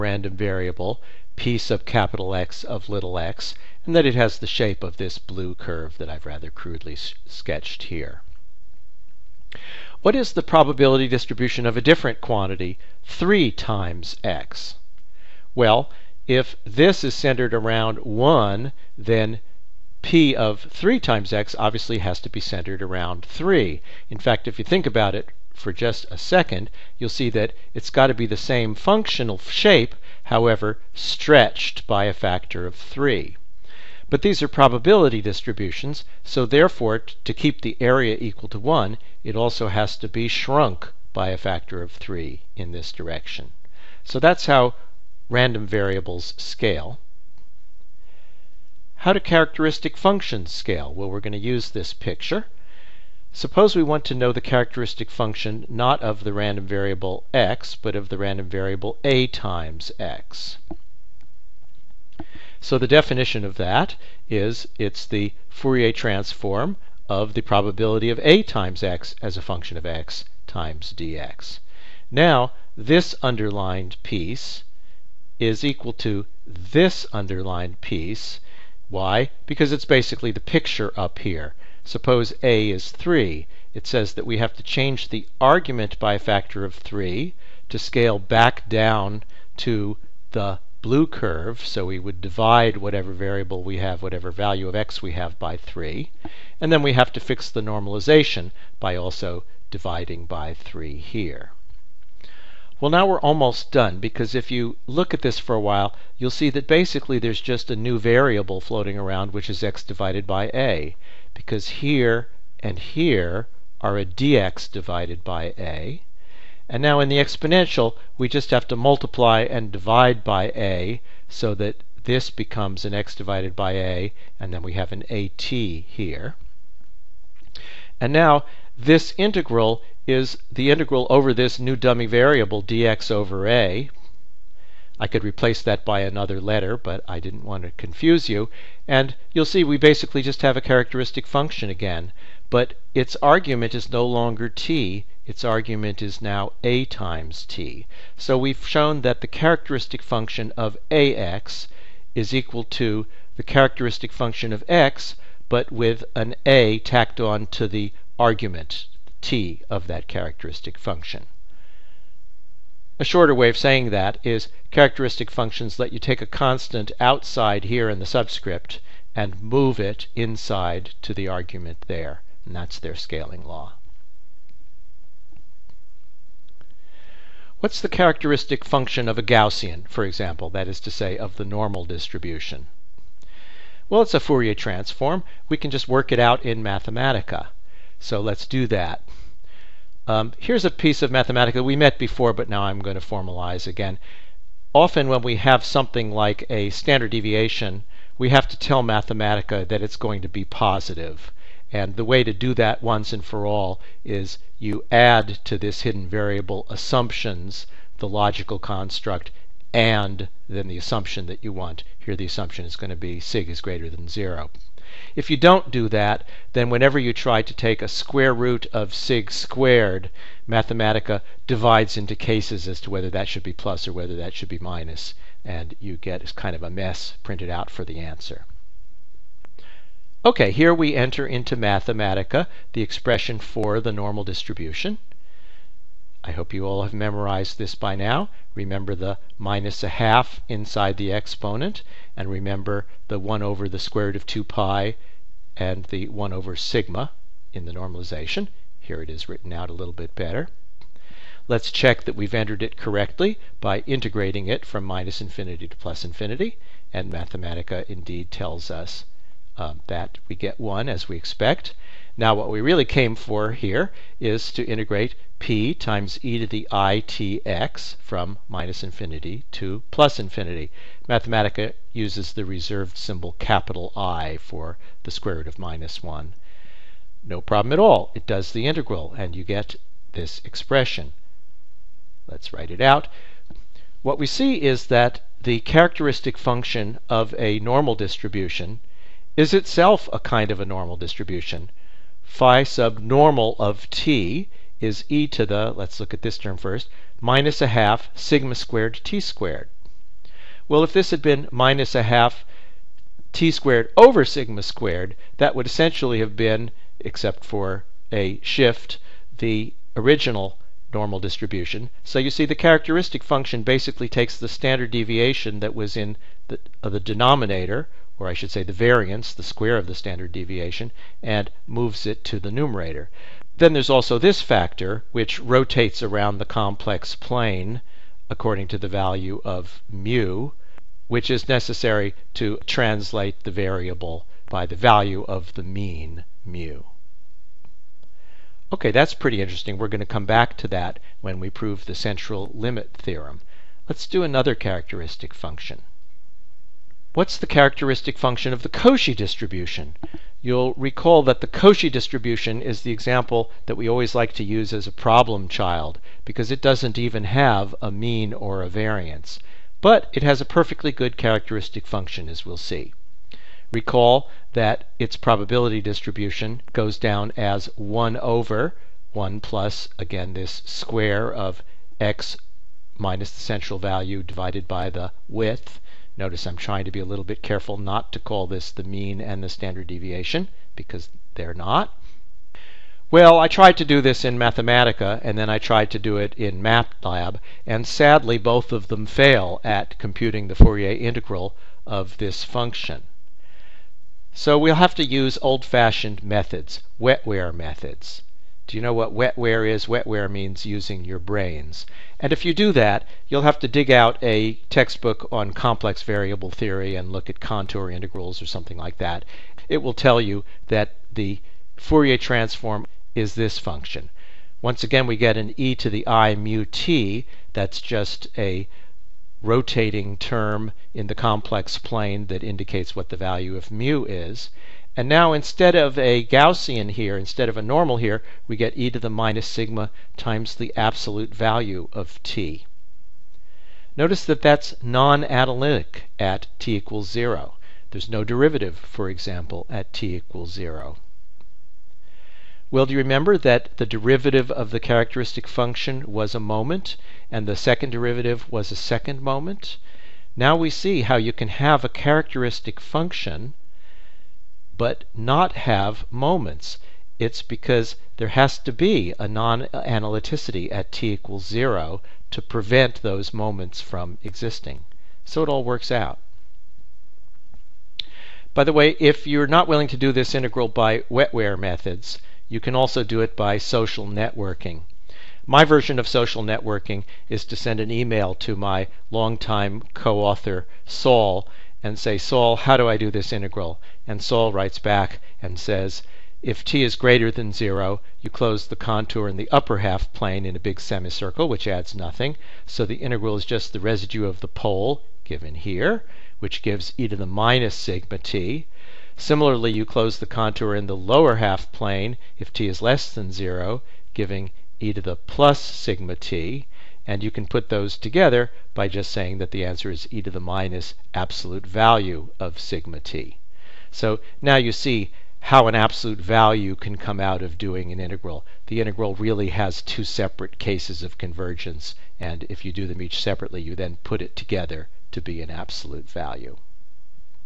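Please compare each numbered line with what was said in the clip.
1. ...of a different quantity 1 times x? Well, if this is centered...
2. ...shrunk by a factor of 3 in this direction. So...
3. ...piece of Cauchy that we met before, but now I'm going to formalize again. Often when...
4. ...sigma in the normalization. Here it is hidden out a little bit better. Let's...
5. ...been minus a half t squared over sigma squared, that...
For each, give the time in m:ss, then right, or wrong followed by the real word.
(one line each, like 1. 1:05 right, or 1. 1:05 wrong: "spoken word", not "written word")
1. 0:11 wrong: "3", not "1"
2. 0:40 right
3. 3:10 wrong: "Mathematica", not "Cauchy"
4. 4:06 wrong: "written", not "hidden"
5. 5:01 right.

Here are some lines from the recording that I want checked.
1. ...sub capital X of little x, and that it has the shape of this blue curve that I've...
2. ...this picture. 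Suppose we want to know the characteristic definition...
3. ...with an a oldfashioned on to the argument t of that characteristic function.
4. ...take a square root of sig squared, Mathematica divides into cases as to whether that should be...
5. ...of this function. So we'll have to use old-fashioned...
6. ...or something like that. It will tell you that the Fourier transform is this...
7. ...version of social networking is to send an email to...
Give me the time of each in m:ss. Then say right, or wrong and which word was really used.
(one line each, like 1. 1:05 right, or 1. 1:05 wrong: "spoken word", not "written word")
1. 0:01 right
2. 0:51 wrong: "function", not "definition"
3. 2:35 wrong: "tacked", not "oldfashioned"
4. 3:37 right
5. 6:31 right
6. 6:48 right
7. 7:55 right.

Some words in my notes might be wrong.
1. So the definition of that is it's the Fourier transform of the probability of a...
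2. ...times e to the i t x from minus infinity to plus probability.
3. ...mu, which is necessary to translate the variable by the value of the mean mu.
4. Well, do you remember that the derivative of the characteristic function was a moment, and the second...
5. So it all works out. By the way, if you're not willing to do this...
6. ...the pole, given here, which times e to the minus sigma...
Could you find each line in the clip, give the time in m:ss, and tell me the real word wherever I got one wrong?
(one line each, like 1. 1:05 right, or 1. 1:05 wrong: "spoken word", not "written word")
1. 1:02 right
2. 4:25 wrong: "infinity", not "probability"
3. 5:29 right
4. 7:22 right
5. 7:45 right
6. 8:14 wrong: "gives", not "times".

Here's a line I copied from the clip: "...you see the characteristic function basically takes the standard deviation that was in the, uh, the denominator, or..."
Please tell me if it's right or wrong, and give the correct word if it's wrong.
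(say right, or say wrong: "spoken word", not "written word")
right.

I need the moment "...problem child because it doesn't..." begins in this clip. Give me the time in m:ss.
5:54.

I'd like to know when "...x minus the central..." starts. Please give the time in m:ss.
6:11.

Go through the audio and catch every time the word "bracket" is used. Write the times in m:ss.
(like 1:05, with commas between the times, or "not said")
not said.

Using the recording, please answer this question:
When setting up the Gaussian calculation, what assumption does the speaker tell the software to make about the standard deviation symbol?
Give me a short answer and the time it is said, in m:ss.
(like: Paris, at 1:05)
sig is greater than 0, at 3:33.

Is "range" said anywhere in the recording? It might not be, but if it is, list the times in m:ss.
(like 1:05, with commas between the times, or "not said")
not said.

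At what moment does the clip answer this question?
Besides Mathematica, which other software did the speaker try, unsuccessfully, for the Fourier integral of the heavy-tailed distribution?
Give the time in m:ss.
6:26.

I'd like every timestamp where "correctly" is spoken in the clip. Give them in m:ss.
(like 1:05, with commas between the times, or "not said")
4:12.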